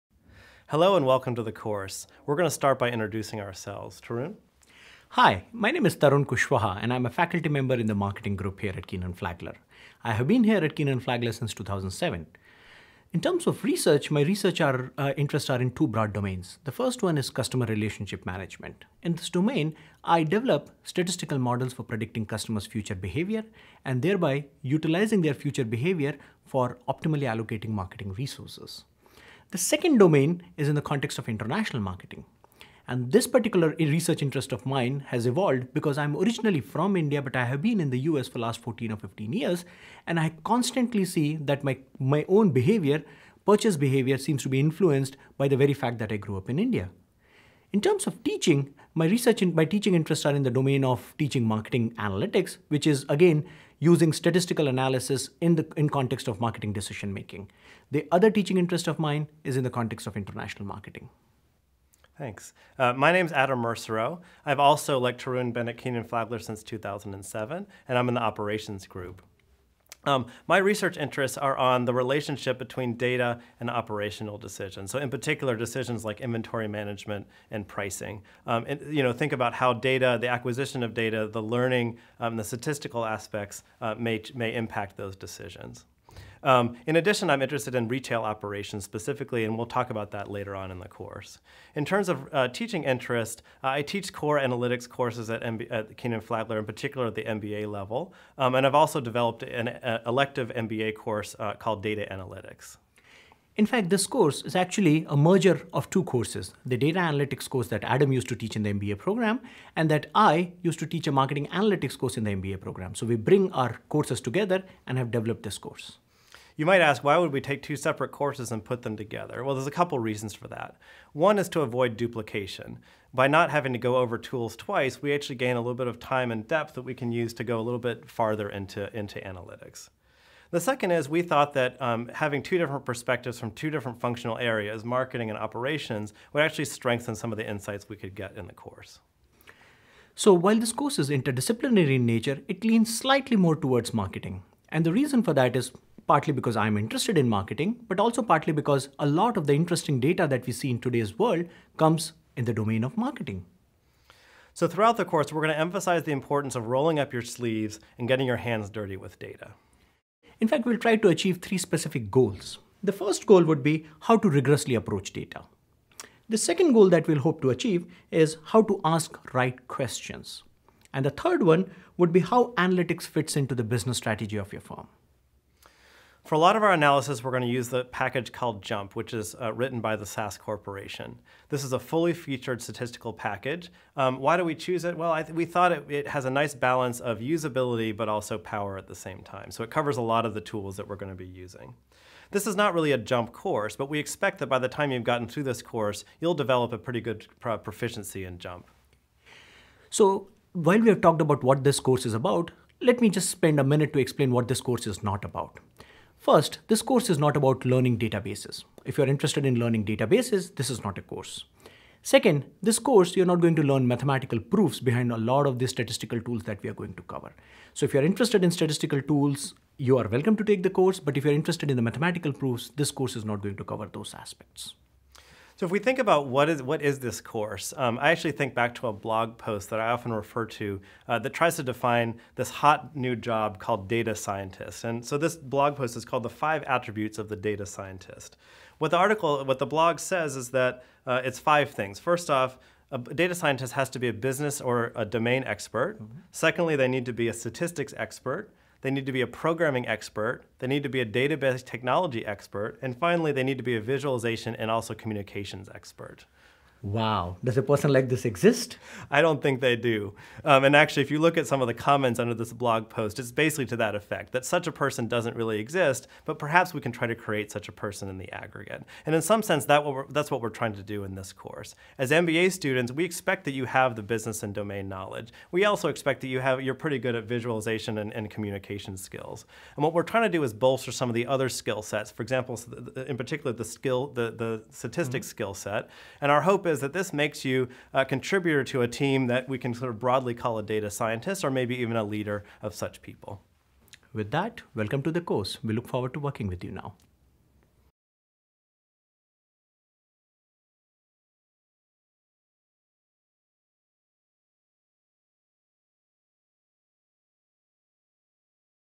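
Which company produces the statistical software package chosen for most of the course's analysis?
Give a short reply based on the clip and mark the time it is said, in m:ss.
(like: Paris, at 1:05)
SAS Corporation, at 3:00.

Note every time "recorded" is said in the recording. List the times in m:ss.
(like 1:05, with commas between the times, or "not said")
not said.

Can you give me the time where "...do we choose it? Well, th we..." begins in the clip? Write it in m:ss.
3:04.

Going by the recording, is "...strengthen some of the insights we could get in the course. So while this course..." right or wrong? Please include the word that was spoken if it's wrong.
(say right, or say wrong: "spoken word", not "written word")
right.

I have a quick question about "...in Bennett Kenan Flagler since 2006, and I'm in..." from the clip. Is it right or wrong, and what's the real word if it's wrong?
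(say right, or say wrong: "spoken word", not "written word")
wrong: "2007", not "2006".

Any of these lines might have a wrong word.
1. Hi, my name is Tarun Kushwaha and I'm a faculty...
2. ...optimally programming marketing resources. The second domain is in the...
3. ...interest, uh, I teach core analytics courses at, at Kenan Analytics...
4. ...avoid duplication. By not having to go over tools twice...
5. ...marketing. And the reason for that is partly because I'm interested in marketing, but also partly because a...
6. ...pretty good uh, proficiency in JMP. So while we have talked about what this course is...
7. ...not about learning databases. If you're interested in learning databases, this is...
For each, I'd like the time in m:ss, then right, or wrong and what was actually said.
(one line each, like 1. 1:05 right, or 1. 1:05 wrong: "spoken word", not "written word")
1. 0:05 right
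2. 0:26 wrong: "allocating", not "programming"
3. 1:32 wrong: "Flagler", not "Analytics"
4. 2:01 right
5. 2:23 right
6. 3:16 right
7. 3:27 right.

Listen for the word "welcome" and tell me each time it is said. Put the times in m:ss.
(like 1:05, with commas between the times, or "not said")
0:01, 3:40, 4:54.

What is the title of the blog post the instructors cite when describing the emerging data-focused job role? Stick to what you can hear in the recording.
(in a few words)
The Five Attributes of the Data Scientist.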